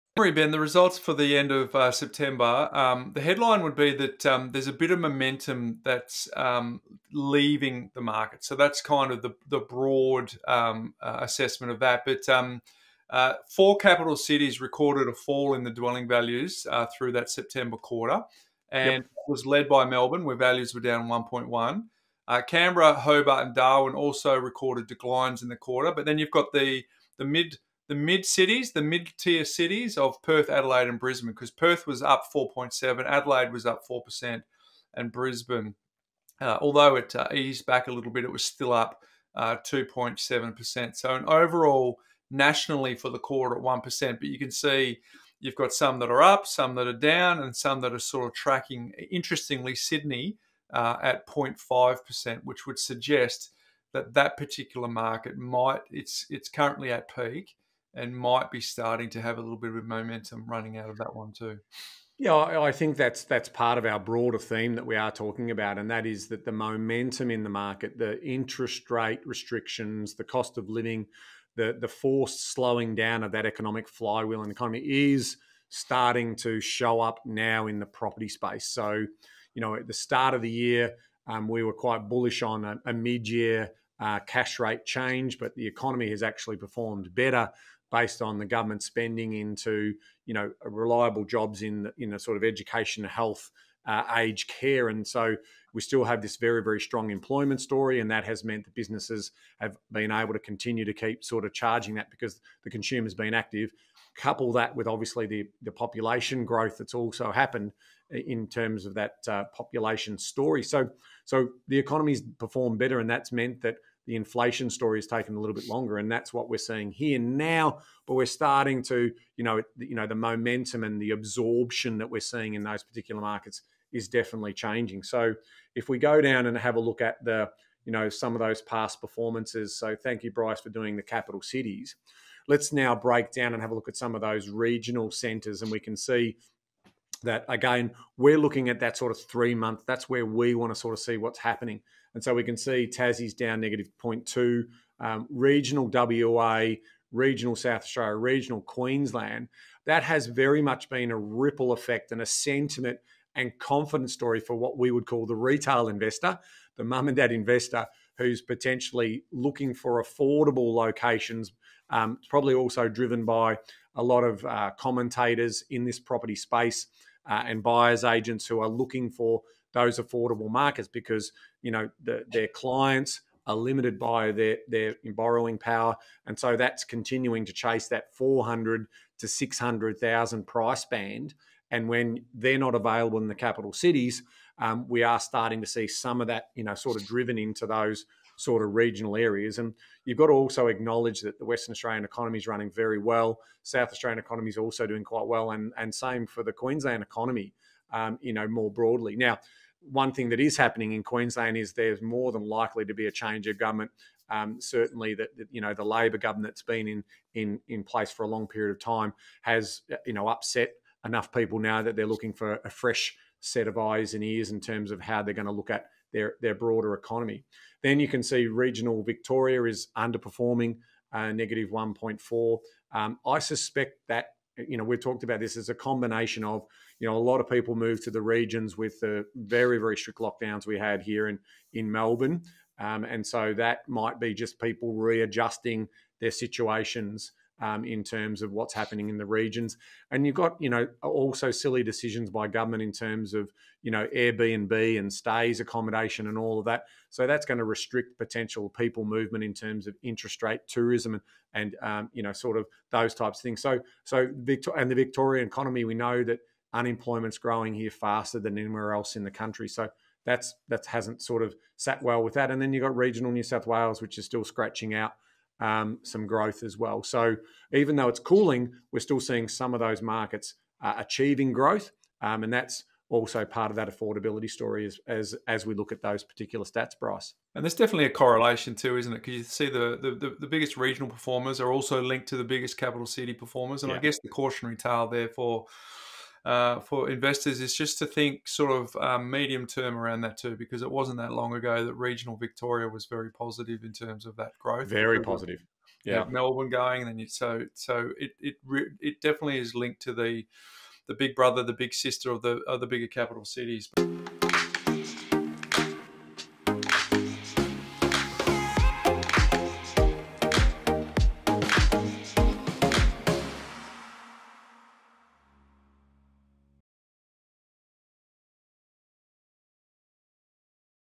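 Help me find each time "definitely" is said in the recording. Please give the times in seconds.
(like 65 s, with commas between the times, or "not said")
124 s, 277 s, 299 s.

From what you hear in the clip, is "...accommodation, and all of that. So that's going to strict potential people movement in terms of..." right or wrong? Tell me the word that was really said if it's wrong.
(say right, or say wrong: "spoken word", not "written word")
wrong: "restrict", not "strict".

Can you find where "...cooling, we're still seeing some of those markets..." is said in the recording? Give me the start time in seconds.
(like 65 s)
268 s.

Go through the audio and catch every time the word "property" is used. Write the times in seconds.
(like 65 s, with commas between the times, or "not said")
77 s, 165 s.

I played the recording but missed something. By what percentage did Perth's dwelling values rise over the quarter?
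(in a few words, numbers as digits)
4.7%.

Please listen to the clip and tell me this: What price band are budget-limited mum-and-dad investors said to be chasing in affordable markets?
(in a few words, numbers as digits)
$400,000 to $600,000.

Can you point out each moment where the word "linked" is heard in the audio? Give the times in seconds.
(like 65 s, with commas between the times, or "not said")
282 s, 299 s.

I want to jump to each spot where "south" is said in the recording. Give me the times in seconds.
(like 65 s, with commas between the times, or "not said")
147 s, 193 s, 263 s.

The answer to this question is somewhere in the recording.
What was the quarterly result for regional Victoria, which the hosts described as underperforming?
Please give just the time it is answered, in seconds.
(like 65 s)
221 s.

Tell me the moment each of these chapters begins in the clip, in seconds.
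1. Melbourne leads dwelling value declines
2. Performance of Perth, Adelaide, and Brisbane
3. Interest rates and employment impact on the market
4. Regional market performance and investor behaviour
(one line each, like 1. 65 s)
1. 22 s
2. 44 s
3. 94 s
4. 162 s.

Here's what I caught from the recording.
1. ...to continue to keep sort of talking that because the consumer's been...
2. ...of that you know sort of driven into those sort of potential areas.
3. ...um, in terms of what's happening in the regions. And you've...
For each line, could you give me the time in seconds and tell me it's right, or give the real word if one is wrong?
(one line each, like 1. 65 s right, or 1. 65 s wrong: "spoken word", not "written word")
1. 100 s wrong: "charging", not "talking"
2. 186 s wrong: "regional", not "potential"
3. 237 s right.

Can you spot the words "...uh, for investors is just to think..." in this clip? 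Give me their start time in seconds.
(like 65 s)
286 s.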